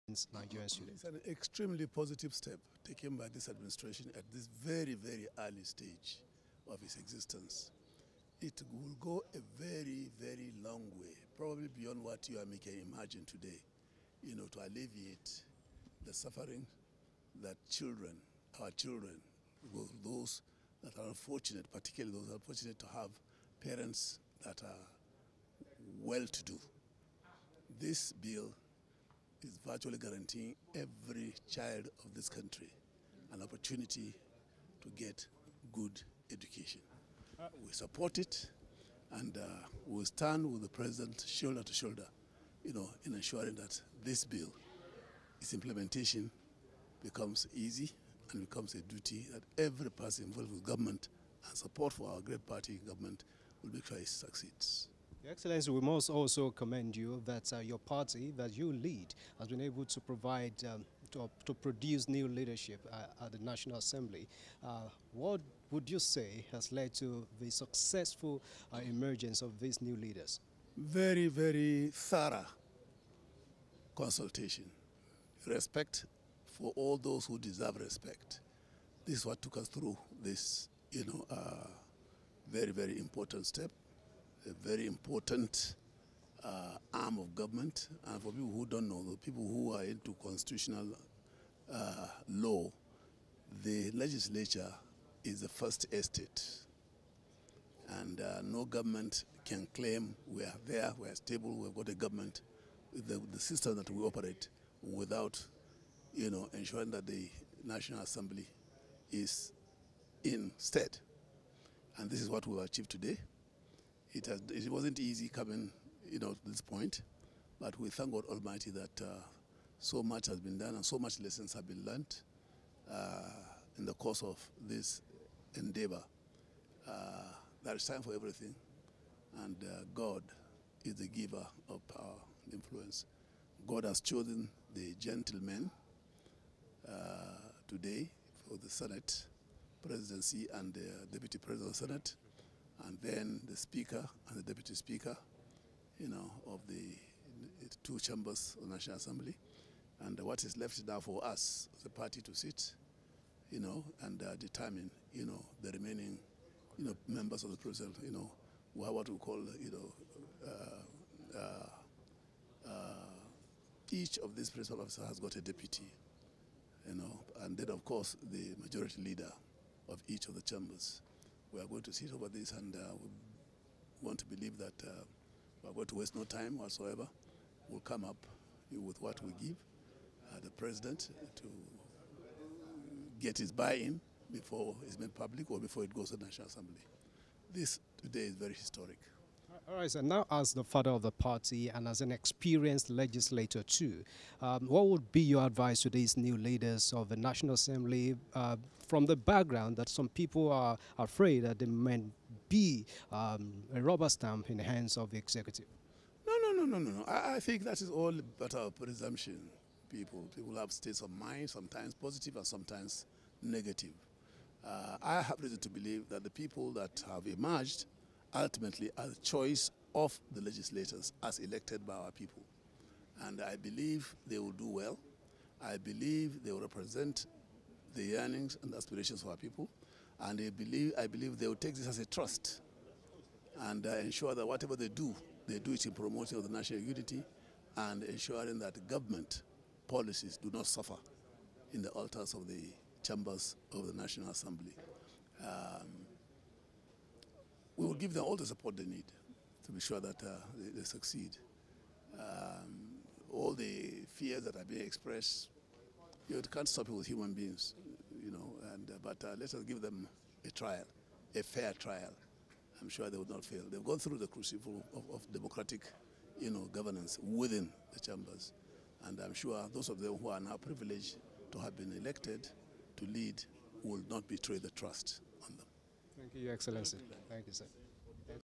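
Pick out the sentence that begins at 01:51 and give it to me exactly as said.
And this is what we've achieved today.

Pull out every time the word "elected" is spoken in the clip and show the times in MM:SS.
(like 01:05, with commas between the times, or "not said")
03:41, 04:31.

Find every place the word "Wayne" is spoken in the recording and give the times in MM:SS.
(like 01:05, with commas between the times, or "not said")
not said.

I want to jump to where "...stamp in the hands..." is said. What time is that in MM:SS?
03:24.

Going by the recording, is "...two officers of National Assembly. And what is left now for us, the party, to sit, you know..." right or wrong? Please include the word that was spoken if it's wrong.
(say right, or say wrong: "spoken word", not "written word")
wrong: "chambers", not "officers".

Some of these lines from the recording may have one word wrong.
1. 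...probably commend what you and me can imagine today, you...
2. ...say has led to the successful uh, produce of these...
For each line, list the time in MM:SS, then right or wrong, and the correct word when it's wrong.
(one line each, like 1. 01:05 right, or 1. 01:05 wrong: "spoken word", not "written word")
1. 00:11 wrong: "beyond", not "commend"
2. 01:05 wrong: "emergence", not "produce".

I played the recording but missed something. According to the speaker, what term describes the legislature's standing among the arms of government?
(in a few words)
The first estate.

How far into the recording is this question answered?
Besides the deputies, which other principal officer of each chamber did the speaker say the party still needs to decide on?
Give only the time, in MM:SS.
02:48.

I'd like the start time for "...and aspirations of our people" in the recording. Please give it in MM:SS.
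03:48.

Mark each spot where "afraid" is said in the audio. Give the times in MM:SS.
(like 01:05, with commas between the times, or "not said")
03:20.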